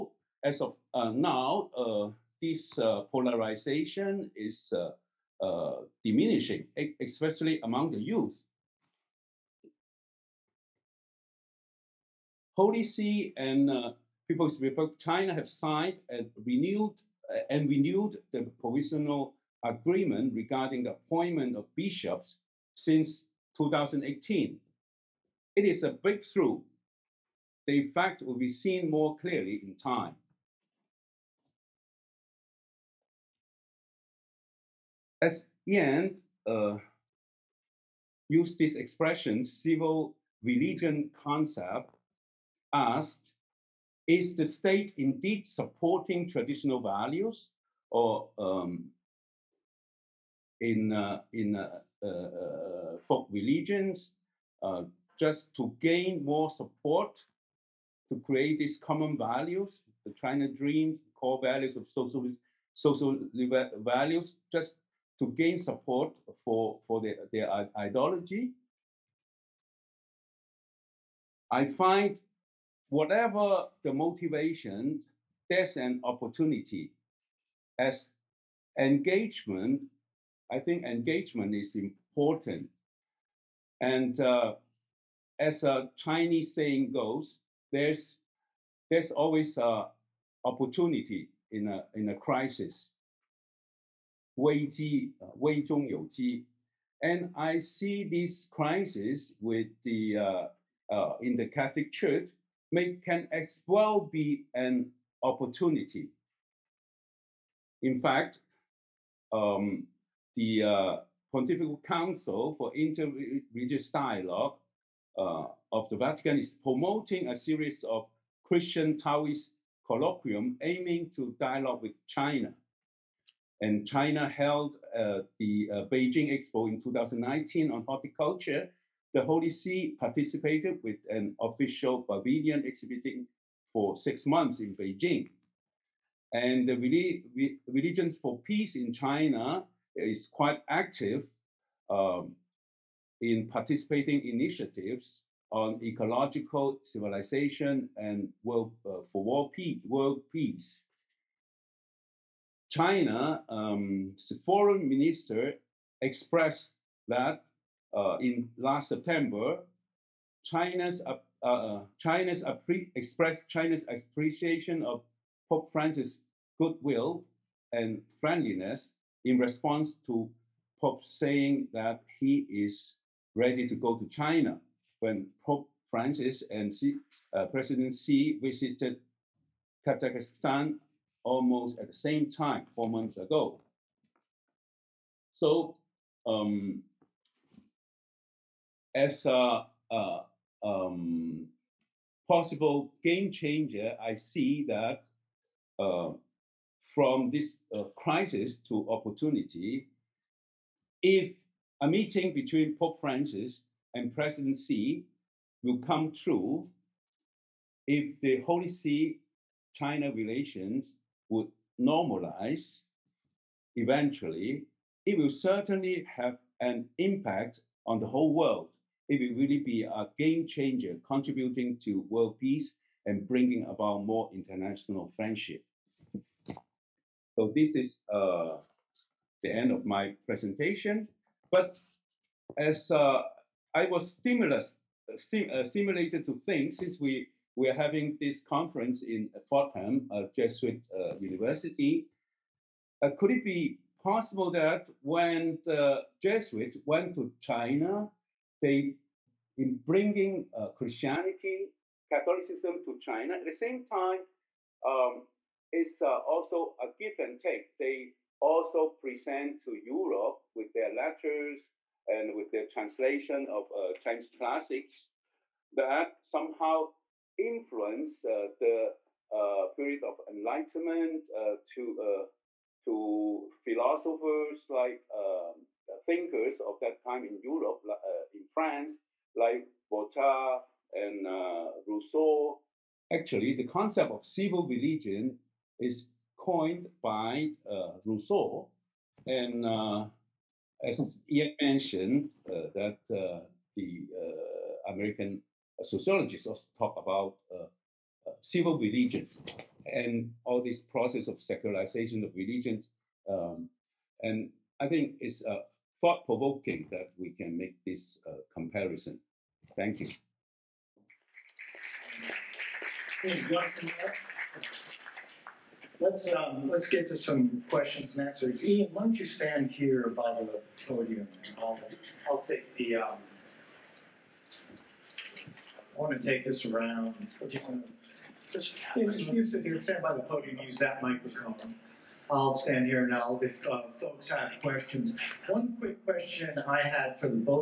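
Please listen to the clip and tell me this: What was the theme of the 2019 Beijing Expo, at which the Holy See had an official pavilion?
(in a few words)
horticulture.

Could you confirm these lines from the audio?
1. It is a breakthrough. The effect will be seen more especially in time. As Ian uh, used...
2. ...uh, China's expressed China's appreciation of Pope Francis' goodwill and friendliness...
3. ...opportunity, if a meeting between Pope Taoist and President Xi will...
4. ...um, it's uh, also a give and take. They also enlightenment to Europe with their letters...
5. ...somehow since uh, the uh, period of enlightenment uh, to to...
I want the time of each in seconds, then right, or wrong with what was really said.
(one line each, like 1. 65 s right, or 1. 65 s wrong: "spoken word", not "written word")
1. 25 s wrong: "clearly", not "especially"
2. 161 s right
3. 198 s wrong: "Francis", not "Taoist"
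4. 254 s wrong: "present", not "enlightenment"
5. 266 s wrong: "influence", not "since".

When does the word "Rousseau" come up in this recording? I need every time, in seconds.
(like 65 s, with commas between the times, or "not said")
281 s, 288 s.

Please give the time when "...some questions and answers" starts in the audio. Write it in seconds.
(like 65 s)
317 s.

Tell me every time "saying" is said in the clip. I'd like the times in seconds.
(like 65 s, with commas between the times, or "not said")
86 s, 171 s.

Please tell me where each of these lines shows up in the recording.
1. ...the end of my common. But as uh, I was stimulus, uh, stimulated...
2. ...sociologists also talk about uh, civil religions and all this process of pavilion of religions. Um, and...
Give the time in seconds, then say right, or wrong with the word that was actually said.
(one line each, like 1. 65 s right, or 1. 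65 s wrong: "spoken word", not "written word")
1. 229 s wrong: "presentation", not "common"
2. 295 s wrong: "secularization", not "pavilion".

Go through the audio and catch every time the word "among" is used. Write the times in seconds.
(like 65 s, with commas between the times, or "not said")
7 s.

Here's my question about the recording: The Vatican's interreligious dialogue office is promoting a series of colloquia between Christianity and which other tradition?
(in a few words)
Taoist.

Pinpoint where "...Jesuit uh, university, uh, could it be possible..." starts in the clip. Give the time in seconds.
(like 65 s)
240 s.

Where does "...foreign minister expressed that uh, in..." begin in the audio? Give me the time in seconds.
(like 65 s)
154 s.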